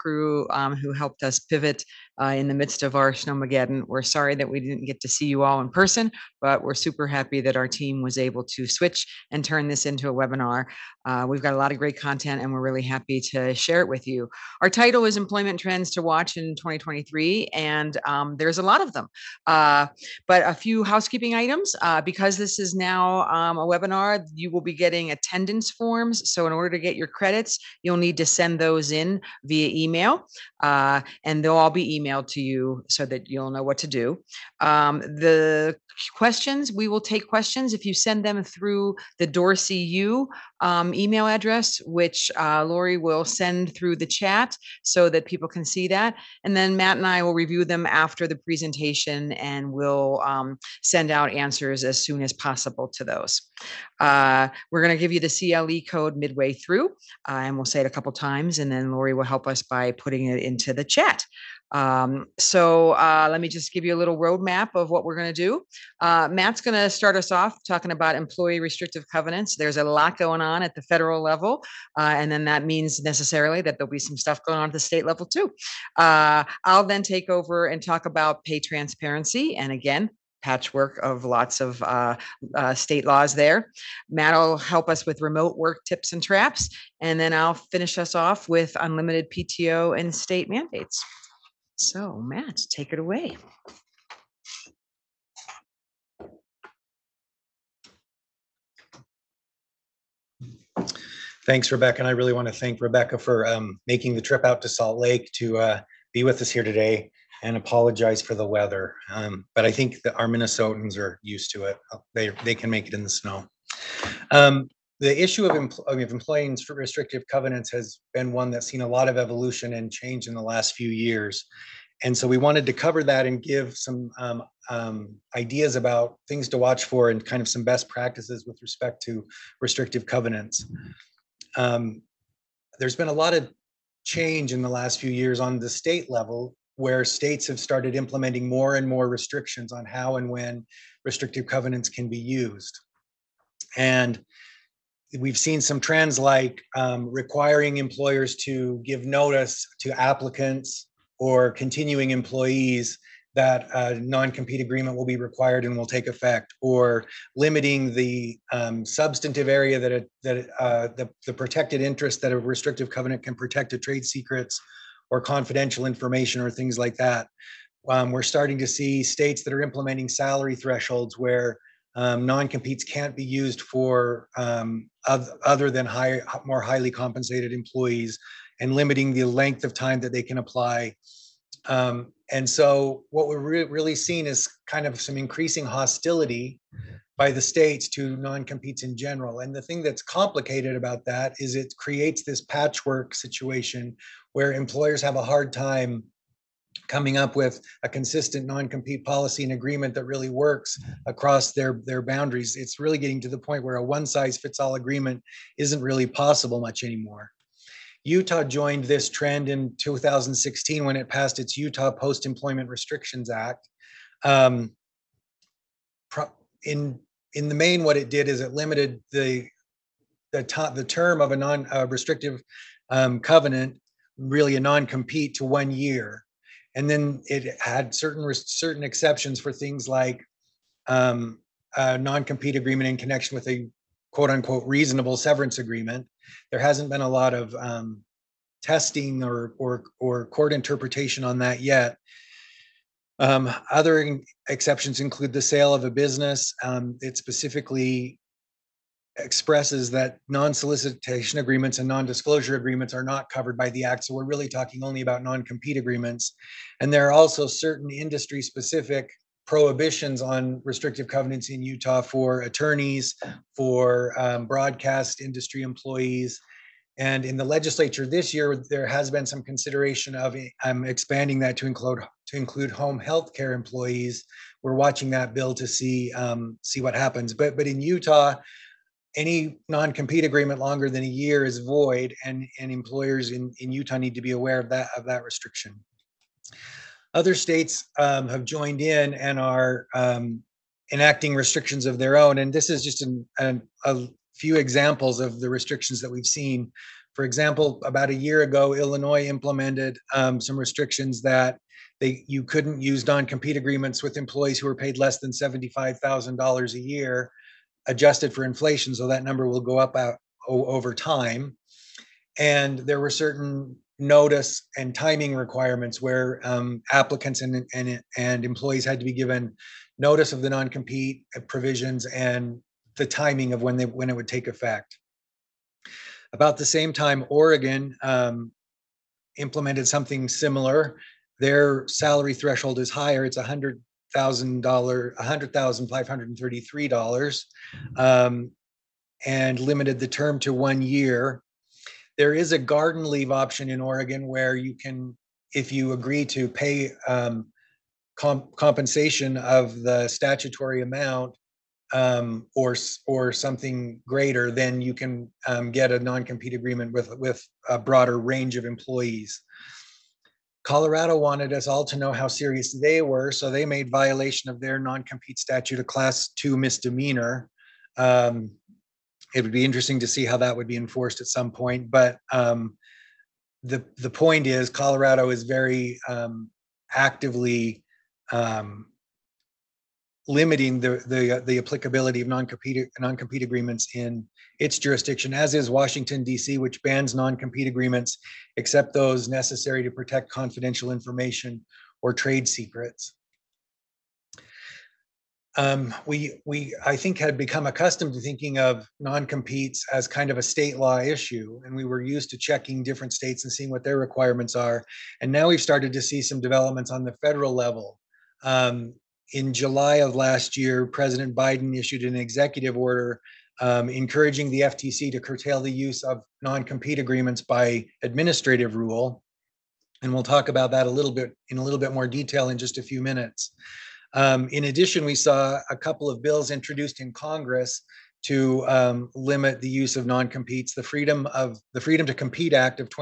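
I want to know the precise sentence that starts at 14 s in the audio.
Our title is Employment Trends to Watch in 2023, and um, there's a lot of them.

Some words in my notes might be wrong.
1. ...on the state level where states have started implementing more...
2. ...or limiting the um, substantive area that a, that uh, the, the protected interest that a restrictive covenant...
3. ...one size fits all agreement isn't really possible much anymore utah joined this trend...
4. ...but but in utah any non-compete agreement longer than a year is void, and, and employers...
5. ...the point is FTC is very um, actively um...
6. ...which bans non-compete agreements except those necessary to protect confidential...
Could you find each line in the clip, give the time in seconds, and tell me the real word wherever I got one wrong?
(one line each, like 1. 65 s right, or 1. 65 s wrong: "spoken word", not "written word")
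1. 135 s right
2. 156 s right
3. 203 s right
4. 277 s right
5. 373 s wrong: "Colorado", not "FTC"
6. 386 s right.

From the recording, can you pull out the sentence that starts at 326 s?
About the same time, Oregon um, implemented something similar.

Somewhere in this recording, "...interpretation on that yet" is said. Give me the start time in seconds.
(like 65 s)
240 s.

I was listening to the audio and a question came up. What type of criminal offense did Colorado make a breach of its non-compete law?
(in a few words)
class two misdemeanor.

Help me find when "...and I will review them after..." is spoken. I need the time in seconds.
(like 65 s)
46 s.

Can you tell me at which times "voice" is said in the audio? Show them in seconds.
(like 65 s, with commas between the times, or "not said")
not said.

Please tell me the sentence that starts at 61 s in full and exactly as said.
Um, so uh, let me just give you a little roadmap of what we're going to do.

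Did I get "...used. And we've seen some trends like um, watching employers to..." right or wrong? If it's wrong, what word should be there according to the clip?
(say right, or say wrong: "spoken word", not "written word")
wrong: "requiring", not "watching".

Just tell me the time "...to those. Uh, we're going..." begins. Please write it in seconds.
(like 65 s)
52 s.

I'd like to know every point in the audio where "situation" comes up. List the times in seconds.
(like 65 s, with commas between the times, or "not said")
193 s.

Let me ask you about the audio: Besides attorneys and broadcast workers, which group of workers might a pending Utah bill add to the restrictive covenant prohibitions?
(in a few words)
home health care employees.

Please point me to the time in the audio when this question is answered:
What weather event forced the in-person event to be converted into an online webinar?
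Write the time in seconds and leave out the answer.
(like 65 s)
3 s.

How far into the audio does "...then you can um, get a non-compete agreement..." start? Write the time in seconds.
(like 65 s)
354 s.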